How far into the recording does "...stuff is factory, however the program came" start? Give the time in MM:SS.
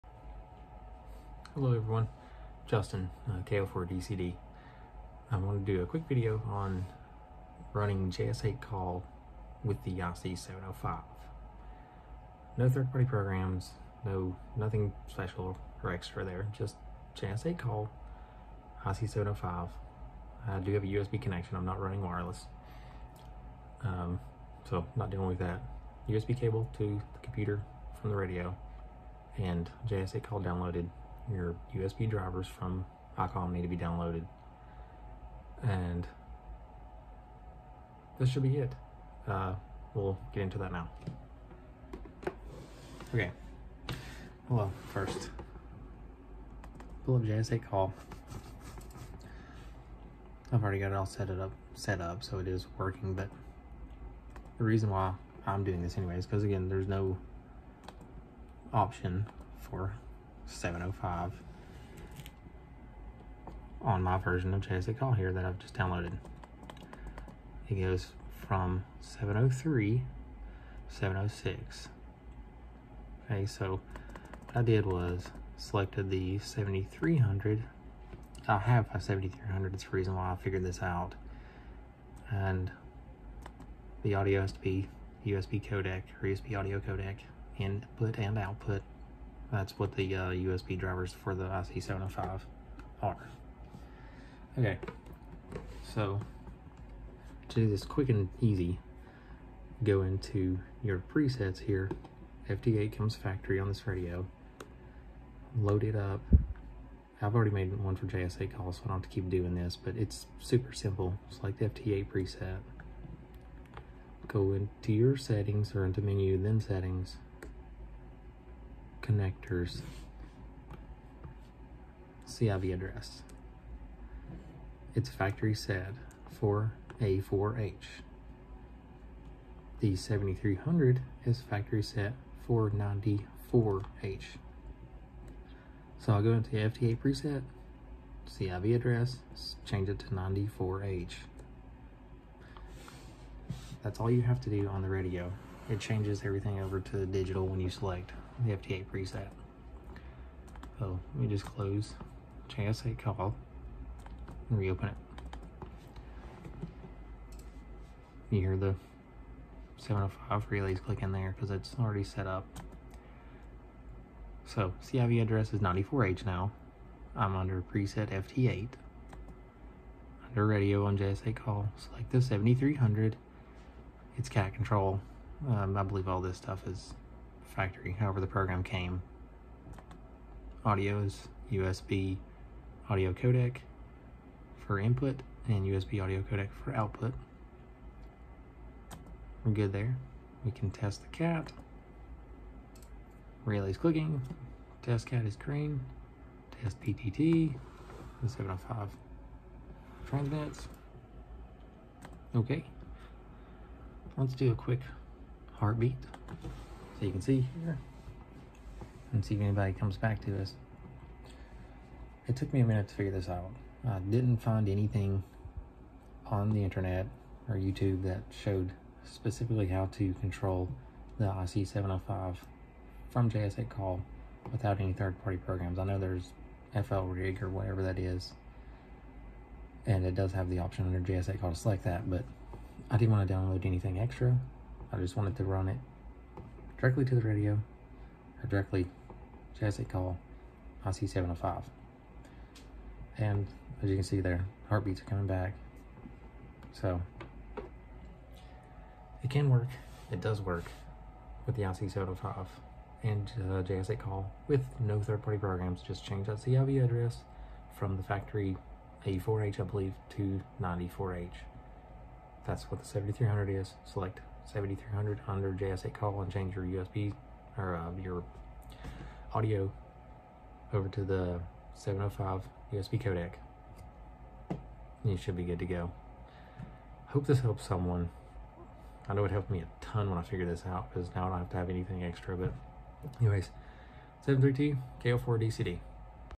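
02:56.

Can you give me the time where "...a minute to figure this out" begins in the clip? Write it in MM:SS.
03:32.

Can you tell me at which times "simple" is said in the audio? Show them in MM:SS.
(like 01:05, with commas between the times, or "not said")
01:50.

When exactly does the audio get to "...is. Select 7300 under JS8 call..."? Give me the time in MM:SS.
04:23.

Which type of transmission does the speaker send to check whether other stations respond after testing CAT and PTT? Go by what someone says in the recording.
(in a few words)
Heartbeat.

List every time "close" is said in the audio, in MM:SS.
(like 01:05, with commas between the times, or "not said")
02:31.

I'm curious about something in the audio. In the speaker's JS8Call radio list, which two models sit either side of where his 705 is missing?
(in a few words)
703 and 706.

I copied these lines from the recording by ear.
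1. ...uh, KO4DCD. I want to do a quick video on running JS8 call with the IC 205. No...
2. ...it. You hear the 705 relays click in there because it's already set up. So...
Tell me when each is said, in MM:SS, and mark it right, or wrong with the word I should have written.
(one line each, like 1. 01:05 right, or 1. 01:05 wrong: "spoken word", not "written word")
1. 00:03 wrong: "705", not "205"
2. 02:34 right.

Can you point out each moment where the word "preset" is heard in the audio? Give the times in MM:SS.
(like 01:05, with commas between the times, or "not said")
01:41, 01:52, 02:16, 02:28, 02:47.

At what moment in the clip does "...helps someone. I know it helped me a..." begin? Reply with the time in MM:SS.
04:37.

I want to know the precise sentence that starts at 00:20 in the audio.
I do have a USB connection, I'm not running wireless, um, so not dealing with that.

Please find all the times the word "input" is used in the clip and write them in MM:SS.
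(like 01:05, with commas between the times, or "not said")
01:27, 03:04.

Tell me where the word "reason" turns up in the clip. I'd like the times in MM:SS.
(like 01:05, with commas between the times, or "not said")
00:54, 01:19.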